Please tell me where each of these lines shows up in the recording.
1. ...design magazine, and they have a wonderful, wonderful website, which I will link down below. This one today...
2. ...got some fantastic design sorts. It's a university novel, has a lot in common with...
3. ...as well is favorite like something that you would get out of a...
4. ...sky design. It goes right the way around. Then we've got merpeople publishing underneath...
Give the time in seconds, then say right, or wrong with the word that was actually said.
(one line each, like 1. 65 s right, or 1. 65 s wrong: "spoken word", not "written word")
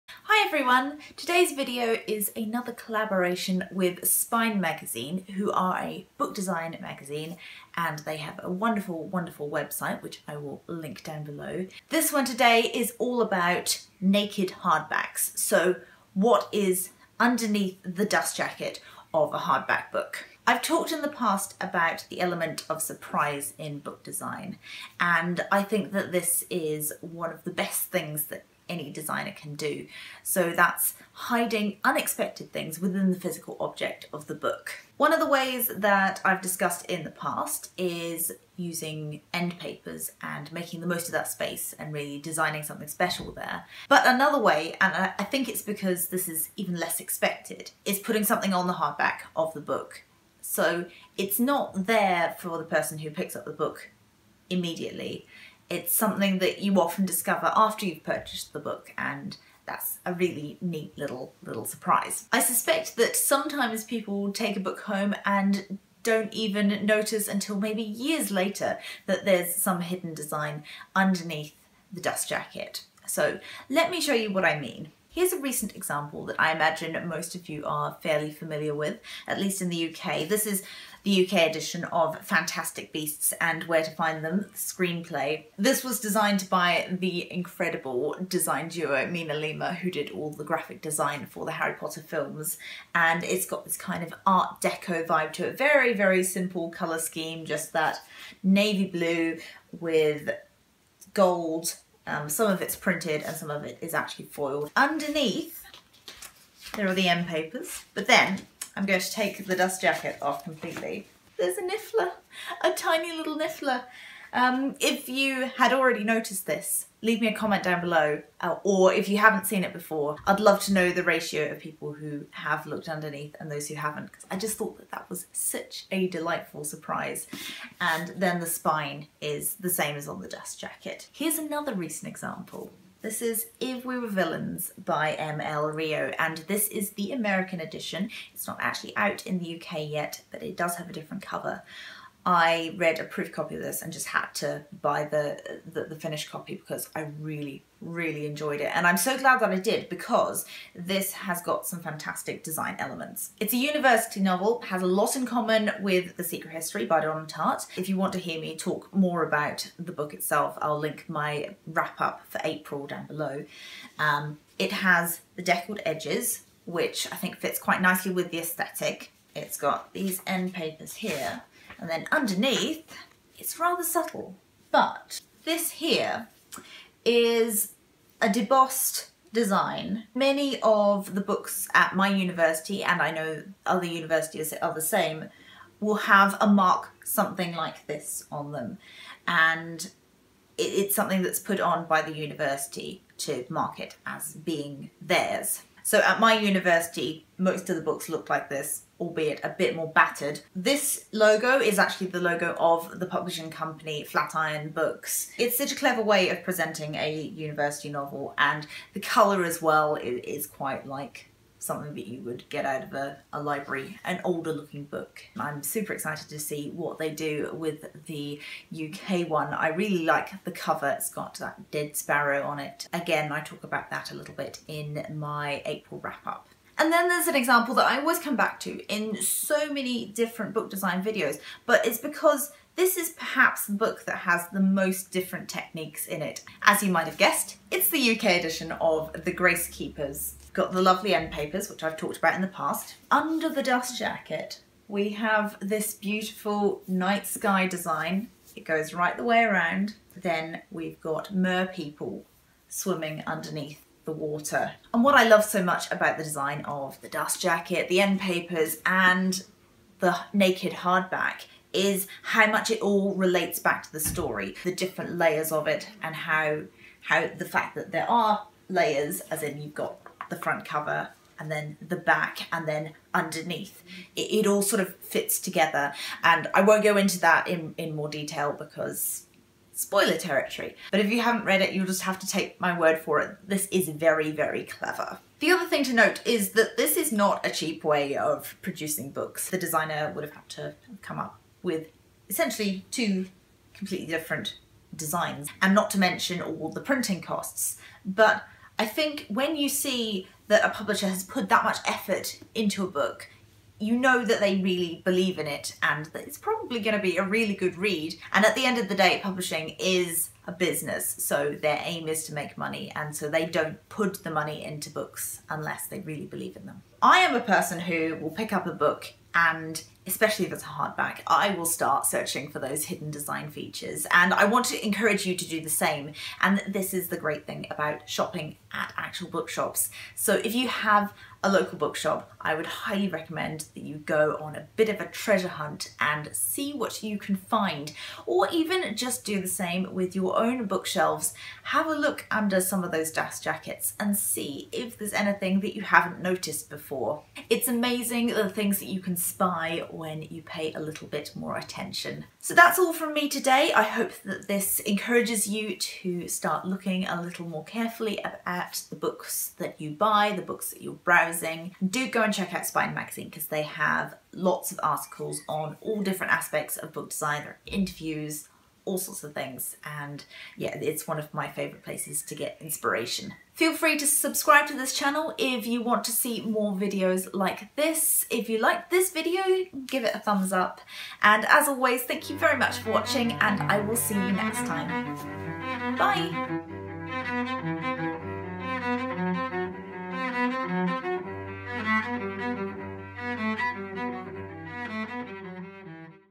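1. 6 s right
2. 151 s wrong: "elements", not "sorts"
3. 209 s wrong: "quite", not "favorite"
4. 247 s wrong: "swimming", not "publishing".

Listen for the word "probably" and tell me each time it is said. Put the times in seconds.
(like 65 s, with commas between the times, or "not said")
306 s.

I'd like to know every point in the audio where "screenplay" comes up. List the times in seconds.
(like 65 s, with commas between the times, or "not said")
84 s.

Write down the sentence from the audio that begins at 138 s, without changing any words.
It's not actually out in the UK yet, but it does have a different cover.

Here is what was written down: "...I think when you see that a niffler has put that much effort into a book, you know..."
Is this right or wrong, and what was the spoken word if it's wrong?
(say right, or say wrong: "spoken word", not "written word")
wrong: "publisher", not "niffler".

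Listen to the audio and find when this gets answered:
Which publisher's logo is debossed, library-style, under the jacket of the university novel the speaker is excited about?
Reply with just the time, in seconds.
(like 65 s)
204 s.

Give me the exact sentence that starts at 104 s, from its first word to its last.
Underneath, there are the end papers, but then I'm going to take the dust jacket off completely.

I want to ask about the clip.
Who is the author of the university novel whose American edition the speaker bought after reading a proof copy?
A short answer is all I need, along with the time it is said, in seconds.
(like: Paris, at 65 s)
ML Rio, at 135 s.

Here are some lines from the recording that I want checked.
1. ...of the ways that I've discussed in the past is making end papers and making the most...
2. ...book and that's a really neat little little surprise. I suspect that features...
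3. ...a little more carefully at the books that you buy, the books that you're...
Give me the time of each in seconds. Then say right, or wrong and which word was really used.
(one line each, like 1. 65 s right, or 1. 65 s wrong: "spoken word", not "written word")
1. 35 s wrong: "using", not "making"
2. 58 s wrong: "sometimes", not "features"
3. 357 s right.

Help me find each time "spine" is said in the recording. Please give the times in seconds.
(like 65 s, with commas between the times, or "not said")
4 s, 128 s, 362 s.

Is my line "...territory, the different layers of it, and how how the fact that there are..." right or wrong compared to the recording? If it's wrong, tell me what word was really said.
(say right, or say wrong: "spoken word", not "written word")
wrong: "story", not "territory".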